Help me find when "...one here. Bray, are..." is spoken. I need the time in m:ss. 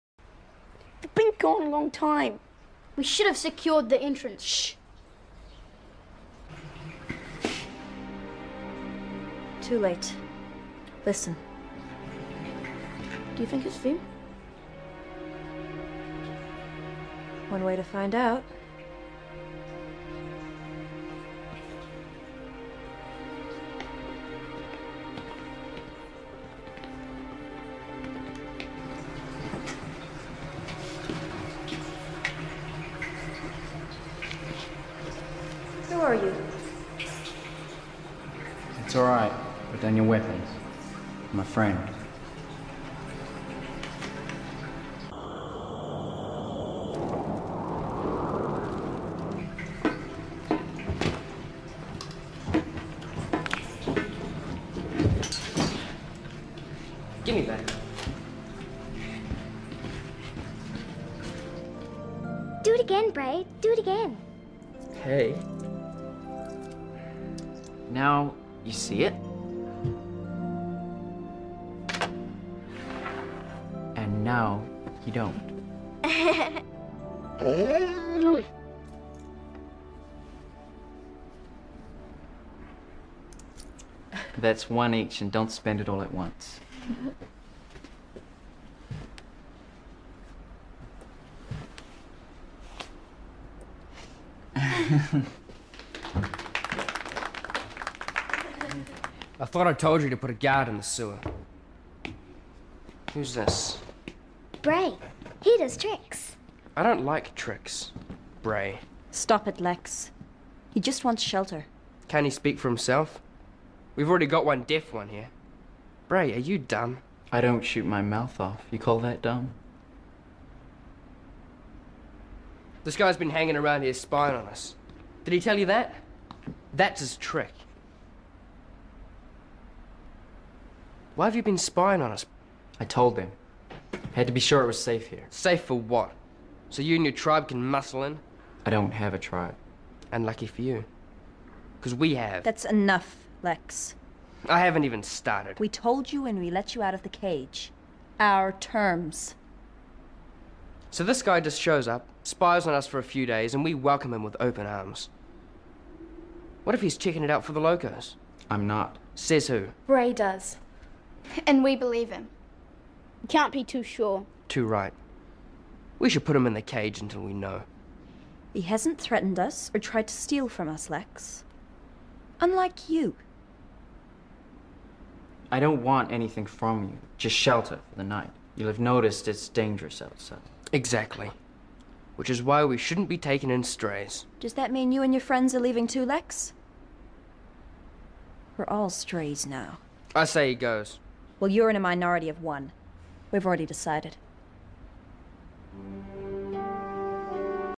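1:54.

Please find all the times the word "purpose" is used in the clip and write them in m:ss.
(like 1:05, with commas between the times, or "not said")
not said.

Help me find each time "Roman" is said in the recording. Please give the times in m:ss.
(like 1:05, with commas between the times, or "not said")
not said.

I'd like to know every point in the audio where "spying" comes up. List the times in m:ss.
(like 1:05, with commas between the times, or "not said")
2:03, 2:11.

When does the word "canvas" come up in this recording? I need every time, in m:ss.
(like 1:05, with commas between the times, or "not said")
not said.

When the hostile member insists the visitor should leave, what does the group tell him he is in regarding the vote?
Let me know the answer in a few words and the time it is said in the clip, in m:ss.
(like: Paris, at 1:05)
A minority of one, at 3:11.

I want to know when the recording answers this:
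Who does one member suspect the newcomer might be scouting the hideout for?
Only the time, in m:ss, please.
2:37.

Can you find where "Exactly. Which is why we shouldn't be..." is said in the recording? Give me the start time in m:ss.
3:00.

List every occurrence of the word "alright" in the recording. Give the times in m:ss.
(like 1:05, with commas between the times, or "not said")
0:38.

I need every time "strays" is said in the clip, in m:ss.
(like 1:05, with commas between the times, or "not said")
3:03, 3:08.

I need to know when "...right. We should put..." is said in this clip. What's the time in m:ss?
2:44.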